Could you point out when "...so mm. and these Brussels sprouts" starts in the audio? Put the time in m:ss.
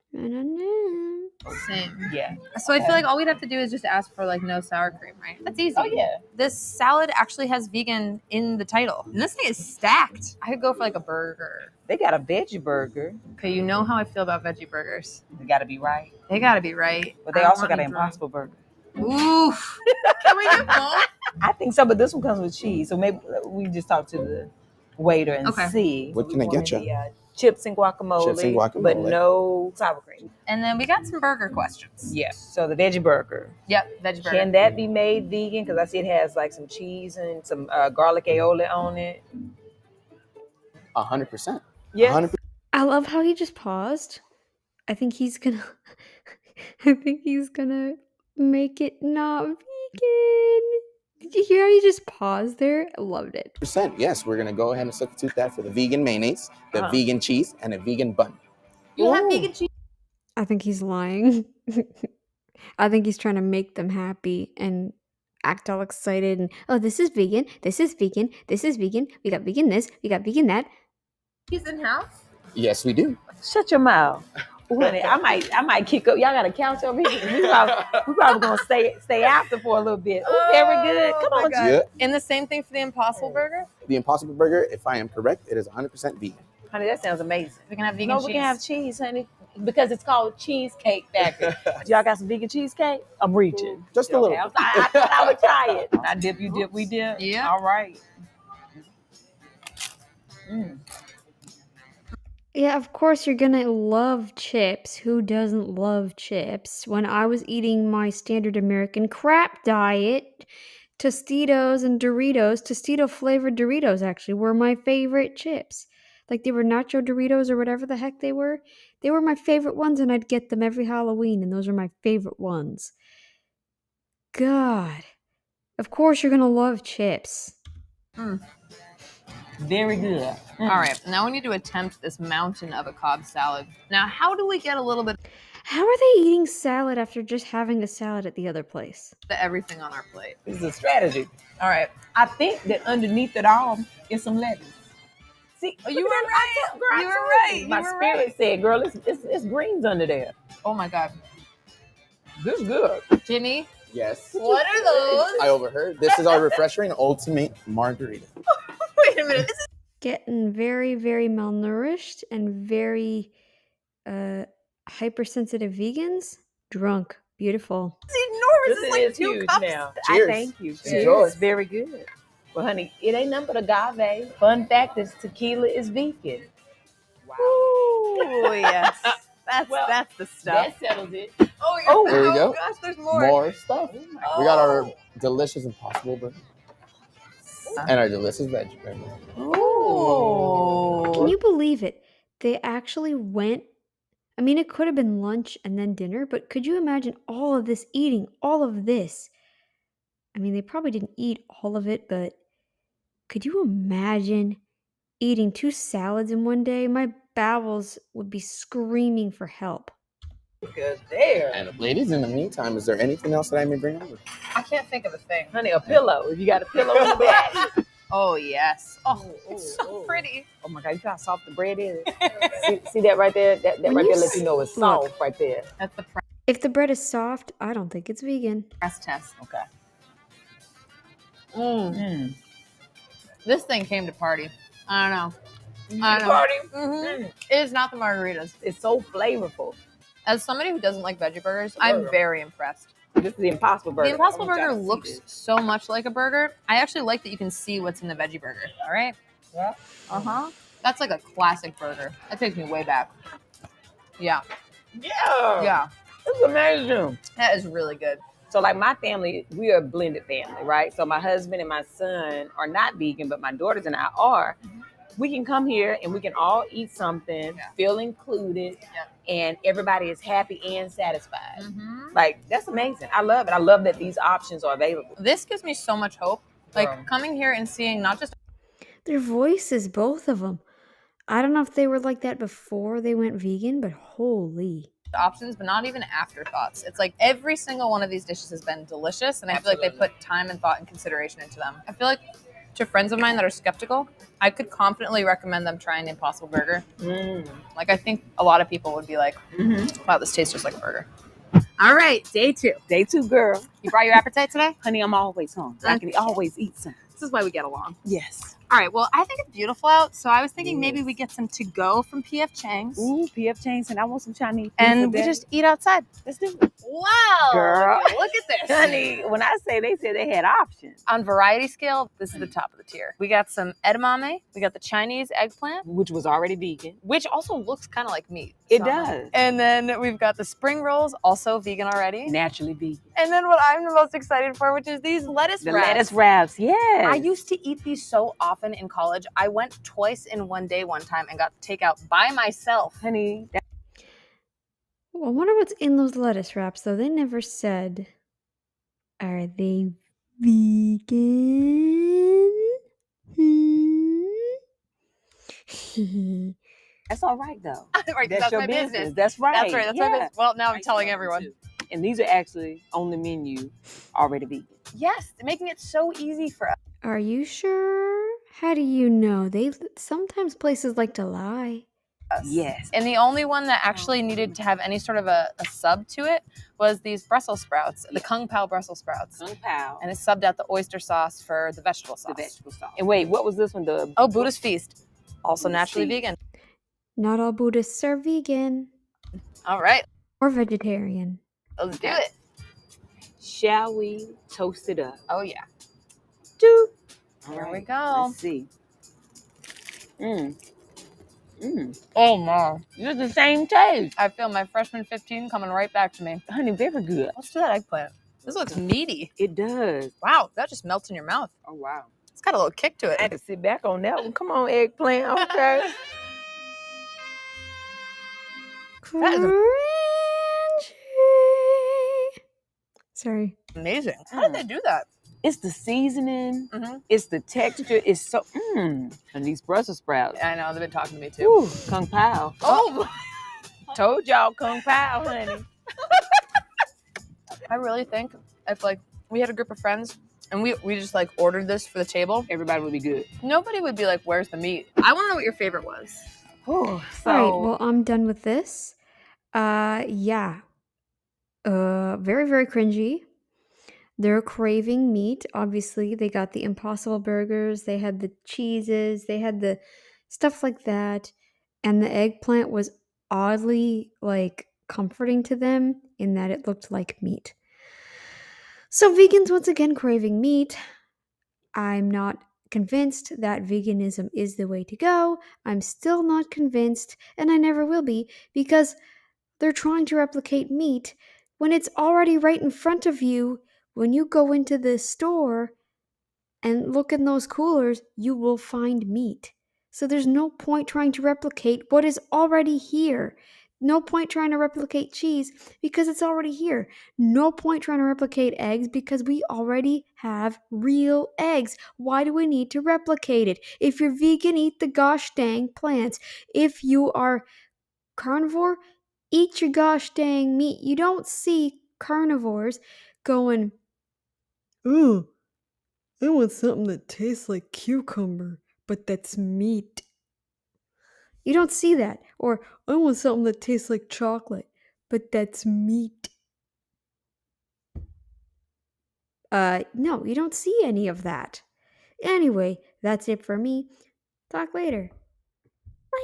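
7:08.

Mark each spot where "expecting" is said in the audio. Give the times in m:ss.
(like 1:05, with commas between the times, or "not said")
not said.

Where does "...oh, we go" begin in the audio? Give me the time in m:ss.
3:02.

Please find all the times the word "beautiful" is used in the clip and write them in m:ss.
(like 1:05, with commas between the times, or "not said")
2:47, 5:09.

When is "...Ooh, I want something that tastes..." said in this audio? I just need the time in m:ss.
8:34.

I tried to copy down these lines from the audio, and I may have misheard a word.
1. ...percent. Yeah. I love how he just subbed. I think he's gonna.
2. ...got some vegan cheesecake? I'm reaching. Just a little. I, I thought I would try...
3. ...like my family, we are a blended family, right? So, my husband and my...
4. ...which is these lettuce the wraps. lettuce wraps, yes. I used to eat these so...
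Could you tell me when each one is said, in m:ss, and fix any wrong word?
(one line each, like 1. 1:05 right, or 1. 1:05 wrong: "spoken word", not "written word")
1. 0:41 wrong: "paused", not "subbed"
2. 1:32 right
3. 4:18 right
4. 5:34 right.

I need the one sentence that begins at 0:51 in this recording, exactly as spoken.
Did you hear how you just paused there?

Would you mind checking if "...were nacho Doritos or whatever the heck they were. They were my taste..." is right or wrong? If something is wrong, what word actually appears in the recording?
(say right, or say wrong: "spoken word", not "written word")
wrong: "favorite", not "taste".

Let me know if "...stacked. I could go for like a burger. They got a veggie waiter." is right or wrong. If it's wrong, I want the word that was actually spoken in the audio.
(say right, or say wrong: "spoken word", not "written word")
wrong: "burger", not "waiter".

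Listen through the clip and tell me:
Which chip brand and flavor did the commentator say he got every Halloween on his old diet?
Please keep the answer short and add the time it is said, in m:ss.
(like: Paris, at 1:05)
Tostito flavored Doritos, at 1:52.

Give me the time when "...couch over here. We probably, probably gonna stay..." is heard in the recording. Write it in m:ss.
1:16.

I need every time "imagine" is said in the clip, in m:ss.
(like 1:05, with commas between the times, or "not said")
3:16, 3:23.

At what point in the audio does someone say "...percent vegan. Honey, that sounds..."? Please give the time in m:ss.
1:25.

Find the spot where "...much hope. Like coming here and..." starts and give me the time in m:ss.
4:35.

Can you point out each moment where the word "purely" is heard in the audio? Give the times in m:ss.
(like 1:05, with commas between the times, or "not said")
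not said.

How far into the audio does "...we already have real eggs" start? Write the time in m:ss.
8:19.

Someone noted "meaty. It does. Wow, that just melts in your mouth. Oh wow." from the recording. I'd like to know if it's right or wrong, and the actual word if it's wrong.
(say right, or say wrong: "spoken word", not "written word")
right.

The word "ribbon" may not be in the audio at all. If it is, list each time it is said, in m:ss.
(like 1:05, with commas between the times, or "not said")
not said.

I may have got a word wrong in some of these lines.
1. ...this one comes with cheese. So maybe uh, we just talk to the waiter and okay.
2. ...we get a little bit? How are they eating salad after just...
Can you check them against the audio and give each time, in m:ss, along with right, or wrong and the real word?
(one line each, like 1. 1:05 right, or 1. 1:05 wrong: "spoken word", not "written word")
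1. 0:21 right
2. 2:14 right.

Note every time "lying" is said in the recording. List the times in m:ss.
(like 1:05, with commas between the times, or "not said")
1:00.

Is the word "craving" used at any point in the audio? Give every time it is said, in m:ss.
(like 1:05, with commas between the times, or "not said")
7:34, 7:49.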